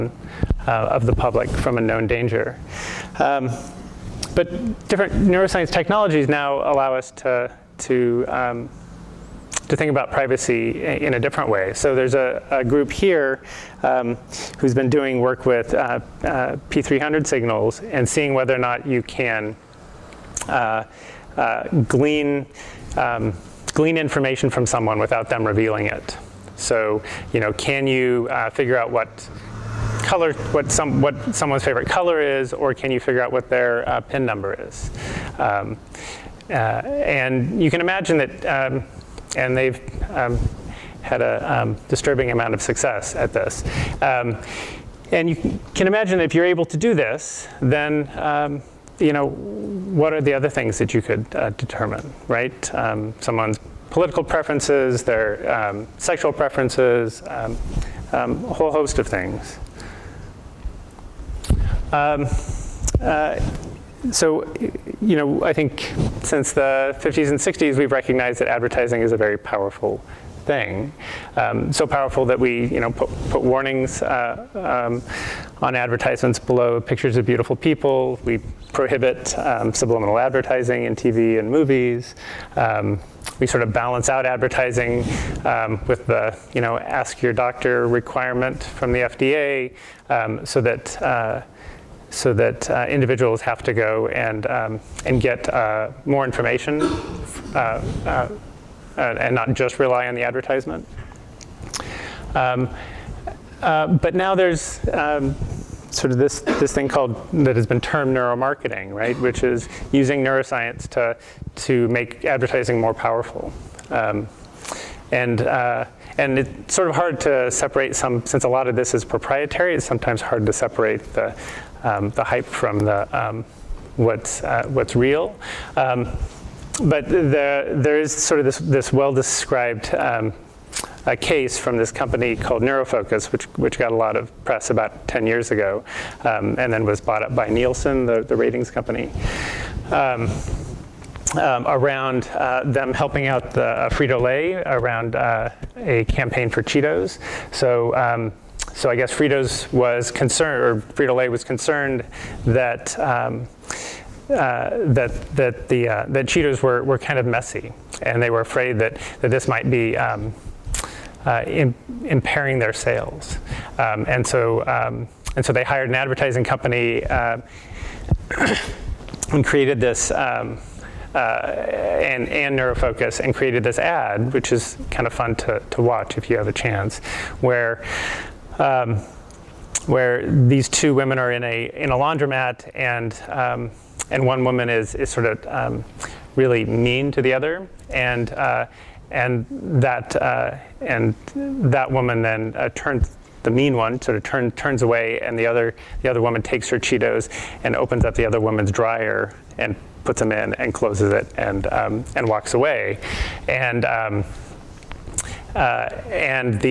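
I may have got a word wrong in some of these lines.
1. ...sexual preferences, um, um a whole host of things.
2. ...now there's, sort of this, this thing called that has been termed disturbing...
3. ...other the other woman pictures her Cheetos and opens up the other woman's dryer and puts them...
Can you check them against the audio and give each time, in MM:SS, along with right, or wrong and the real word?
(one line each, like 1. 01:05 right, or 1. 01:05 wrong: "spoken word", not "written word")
1. 00:55 right
2. 01:44 wrong: "neuromarketing", not "disturbing"
3. 03:15 wrong: "takes", not "pictures".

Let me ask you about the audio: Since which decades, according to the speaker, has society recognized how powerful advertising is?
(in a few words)
50s and 60s.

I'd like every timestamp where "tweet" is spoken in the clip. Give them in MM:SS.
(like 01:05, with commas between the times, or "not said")
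not said.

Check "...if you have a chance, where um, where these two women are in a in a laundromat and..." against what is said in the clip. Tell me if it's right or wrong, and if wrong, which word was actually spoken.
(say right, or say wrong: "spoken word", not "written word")
right.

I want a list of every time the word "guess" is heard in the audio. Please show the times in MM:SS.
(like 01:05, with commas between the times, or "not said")
02:28.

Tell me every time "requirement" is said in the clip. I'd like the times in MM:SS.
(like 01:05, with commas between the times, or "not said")
01:27.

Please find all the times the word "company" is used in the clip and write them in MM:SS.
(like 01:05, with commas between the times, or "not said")
02:11, 02:18, 02:46.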